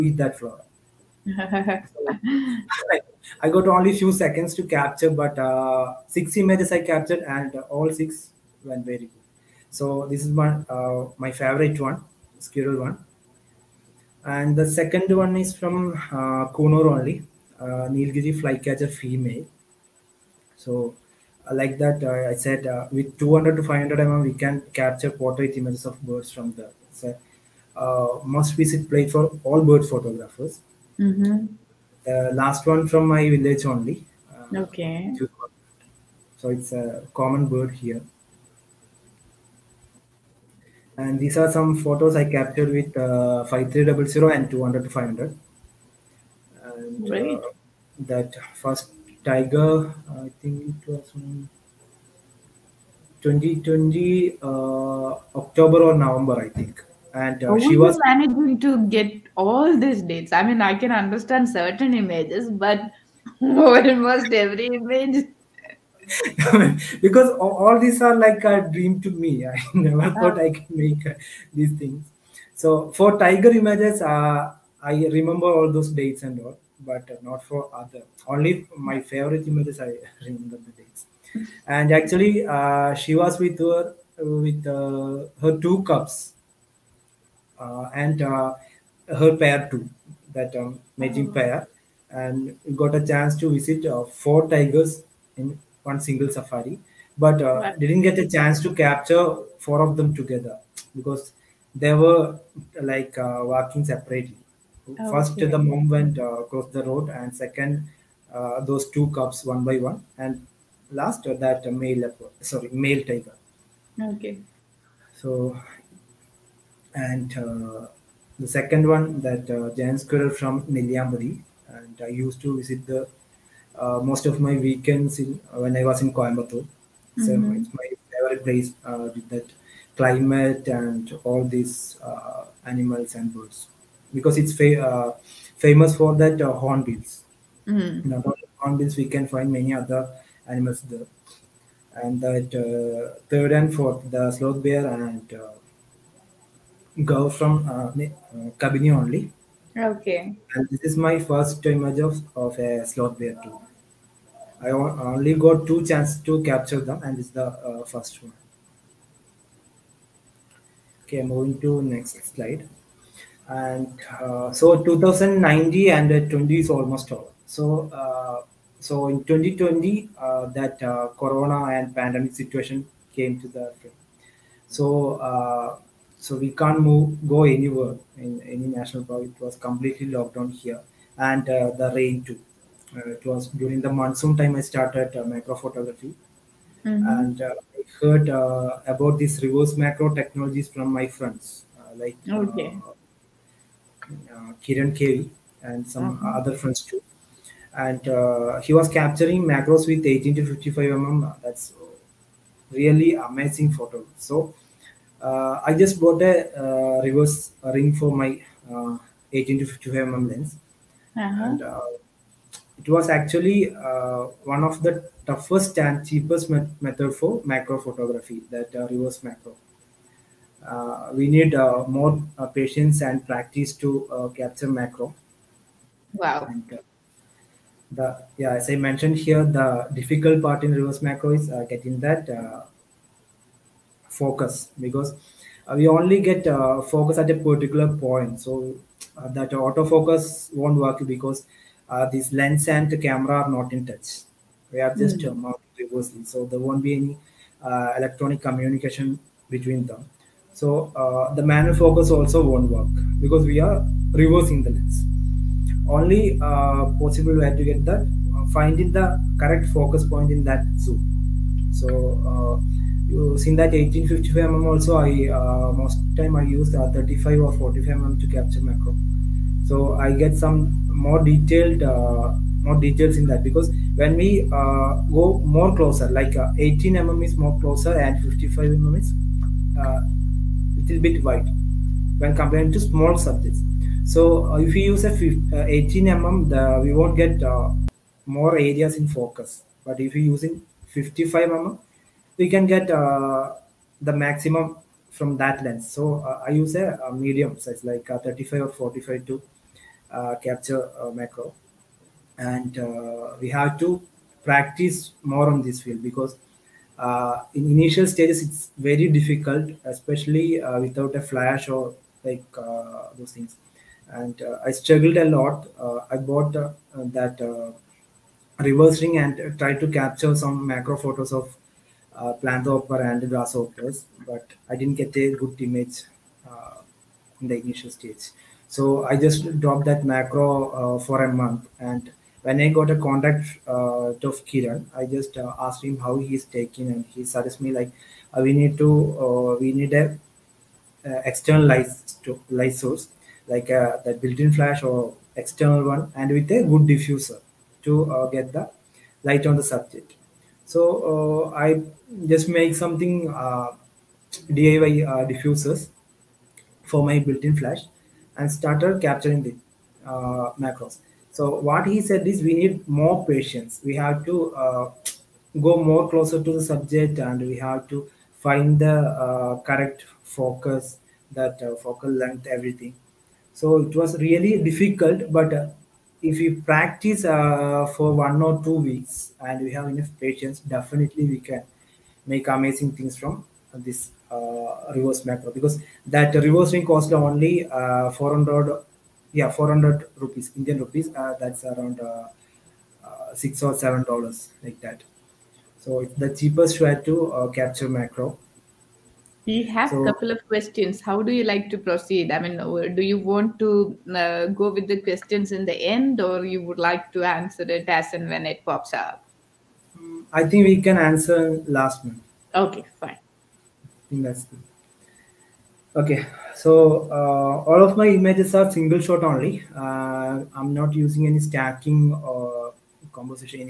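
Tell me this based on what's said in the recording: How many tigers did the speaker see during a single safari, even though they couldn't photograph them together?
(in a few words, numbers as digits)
4.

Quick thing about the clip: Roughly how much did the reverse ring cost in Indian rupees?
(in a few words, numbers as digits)
400 rupees.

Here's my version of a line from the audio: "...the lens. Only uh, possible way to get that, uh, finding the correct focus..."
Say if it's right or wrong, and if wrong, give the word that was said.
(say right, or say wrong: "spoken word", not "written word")
right.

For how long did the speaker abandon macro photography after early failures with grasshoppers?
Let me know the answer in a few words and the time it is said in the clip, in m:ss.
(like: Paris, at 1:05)
a month, at 5:31.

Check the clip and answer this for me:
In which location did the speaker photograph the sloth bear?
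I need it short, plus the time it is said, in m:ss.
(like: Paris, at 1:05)
Kabini, at 2:28.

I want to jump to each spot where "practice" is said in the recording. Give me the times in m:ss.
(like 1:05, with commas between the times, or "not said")
3:43, 5:04, 6:16.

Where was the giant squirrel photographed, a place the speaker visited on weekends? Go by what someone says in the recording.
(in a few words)
Nelliampathy.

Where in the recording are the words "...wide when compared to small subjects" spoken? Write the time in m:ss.
4:41.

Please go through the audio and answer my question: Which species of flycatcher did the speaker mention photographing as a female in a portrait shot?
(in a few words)
Nilgiri flycatcher.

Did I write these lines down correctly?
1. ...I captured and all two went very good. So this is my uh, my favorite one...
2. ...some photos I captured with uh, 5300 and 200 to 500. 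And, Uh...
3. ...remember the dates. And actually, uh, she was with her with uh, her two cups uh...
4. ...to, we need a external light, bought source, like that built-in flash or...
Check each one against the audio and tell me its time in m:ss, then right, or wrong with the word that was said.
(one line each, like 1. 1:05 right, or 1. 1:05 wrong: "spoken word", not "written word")
1. 0:06 wrong: "six", not "two"
2. 0:41 right
3. 1:20 right
4. 5:38 wrong: "light", not "bought".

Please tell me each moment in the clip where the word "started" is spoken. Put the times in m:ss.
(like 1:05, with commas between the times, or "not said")
3:04, 5:58.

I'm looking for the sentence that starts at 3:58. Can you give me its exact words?
So uh, that autofocus won't work because this lens and the camera are not in touch.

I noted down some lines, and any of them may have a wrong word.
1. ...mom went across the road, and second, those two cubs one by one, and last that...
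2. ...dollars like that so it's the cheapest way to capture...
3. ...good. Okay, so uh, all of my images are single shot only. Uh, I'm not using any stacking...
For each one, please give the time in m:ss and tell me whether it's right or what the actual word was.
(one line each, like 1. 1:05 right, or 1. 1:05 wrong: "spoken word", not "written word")
1. 1:45 right
2. 6:34 right
3. 6:54 right.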